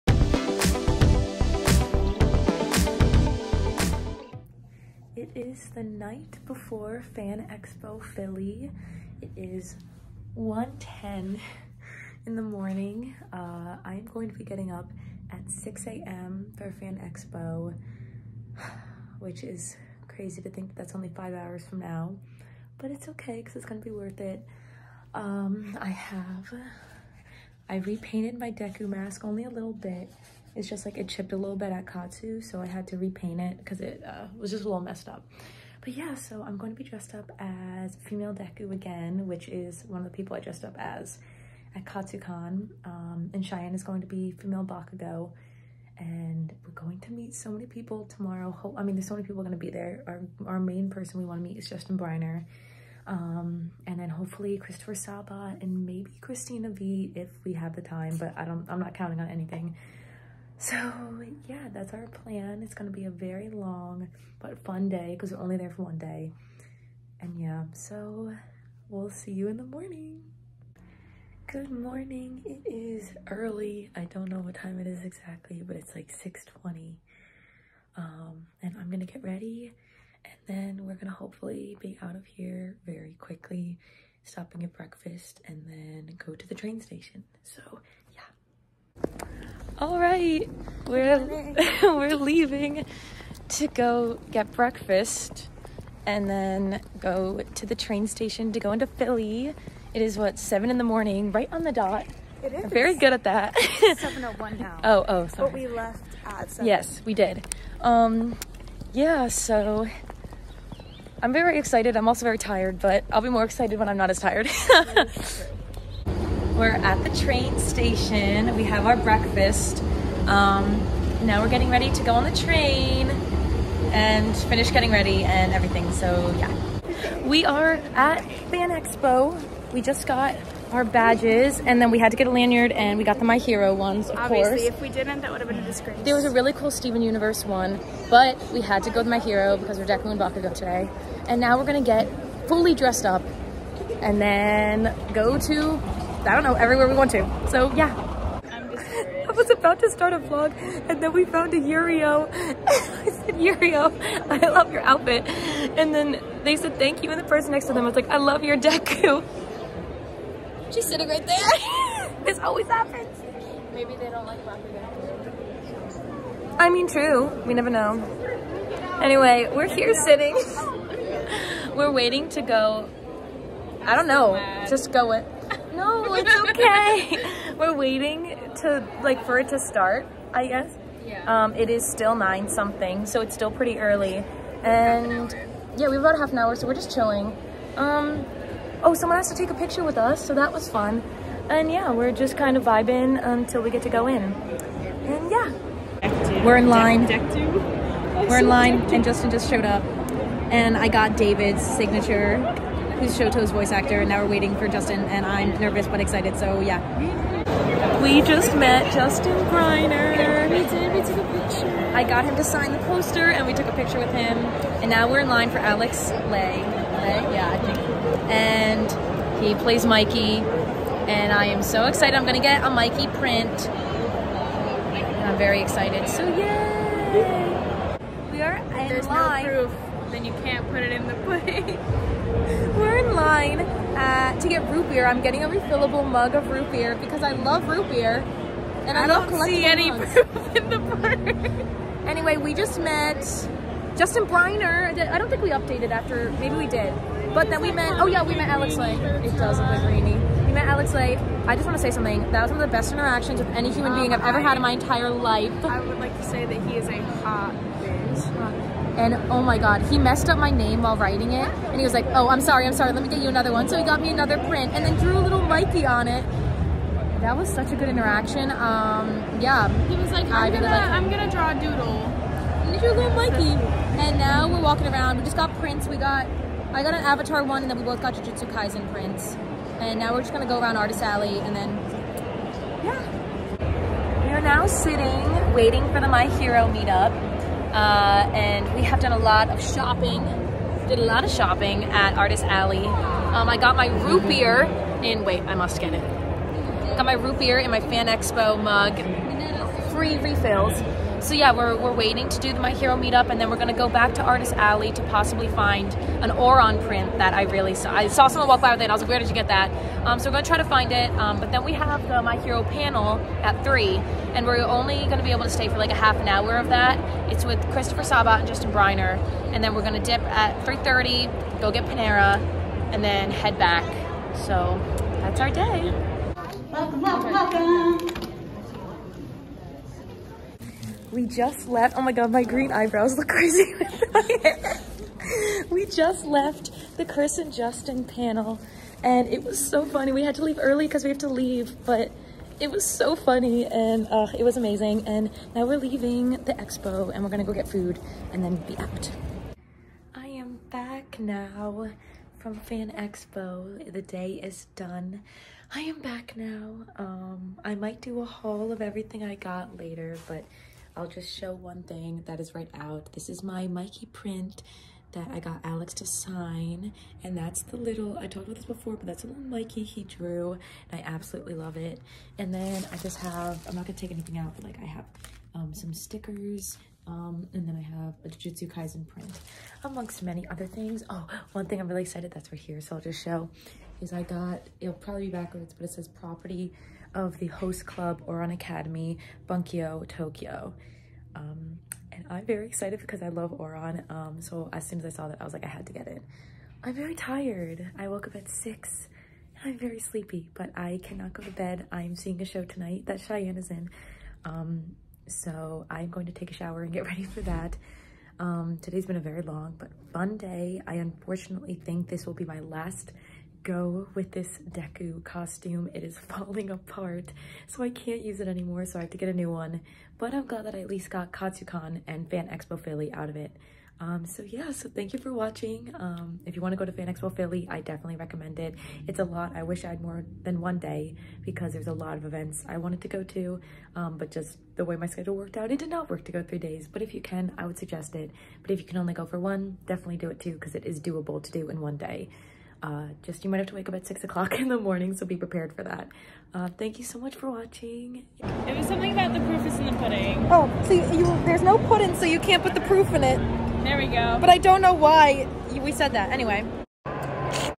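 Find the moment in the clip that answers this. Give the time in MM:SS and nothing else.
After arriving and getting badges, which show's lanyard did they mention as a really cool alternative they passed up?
02:16.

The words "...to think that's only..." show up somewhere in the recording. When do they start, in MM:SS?
00:20.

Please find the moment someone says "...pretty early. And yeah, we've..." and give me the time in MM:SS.
03:03.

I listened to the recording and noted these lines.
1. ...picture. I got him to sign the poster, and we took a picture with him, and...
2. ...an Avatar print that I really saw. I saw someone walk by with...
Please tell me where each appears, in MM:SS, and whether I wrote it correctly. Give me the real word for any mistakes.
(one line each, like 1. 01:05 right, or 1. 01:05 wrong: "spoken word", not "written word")
1. 03:31 right
2. 05:06 wrong: "Ouran", not "Avatar".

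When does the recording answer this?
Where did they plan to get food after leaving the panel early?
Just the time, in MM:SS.
05:21.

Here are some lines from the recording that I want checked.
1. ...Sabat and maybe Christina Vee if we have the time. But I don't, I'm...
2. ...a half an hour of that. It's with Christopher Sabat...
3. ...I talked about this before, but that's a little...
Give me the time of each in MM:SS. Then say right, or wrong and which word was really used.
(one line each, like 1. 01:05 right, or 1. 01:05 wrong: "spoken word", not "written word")
1. 00:54 right
2. 05:15 right
3. 06:08 right.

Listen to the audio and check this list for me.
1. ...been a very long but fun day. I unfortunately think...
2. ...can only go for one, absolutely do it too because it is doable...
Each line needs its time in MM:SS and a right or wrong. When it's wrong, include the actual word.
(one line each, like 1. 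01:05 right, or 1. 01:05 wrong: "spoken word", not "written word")
1. 06:49 right
2. 07:18 wrong: "definitely", not "absolutely".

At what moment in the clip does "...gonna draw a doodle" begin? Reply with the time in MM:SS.
04:31.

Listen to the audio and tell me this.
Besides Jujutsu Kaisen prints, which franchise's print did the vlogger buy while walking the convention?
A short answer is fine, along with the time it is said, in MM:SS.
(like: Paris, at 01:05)
Avatar, at 04:37.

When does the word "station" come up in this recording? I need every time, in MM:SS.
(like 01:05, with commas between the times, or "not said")
01:26, 01:38, 01:57.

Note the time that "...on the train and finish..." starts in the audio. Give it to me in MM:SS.
02:02.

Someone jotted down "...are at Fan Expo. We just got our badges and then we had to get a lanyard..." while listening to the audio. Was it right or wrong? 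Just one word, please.
right.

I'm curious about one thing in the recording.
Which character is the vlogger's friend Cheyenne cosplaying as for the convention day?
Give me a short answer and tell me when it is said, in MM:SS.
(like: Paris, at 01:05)
Female Bakugo, at 00:44.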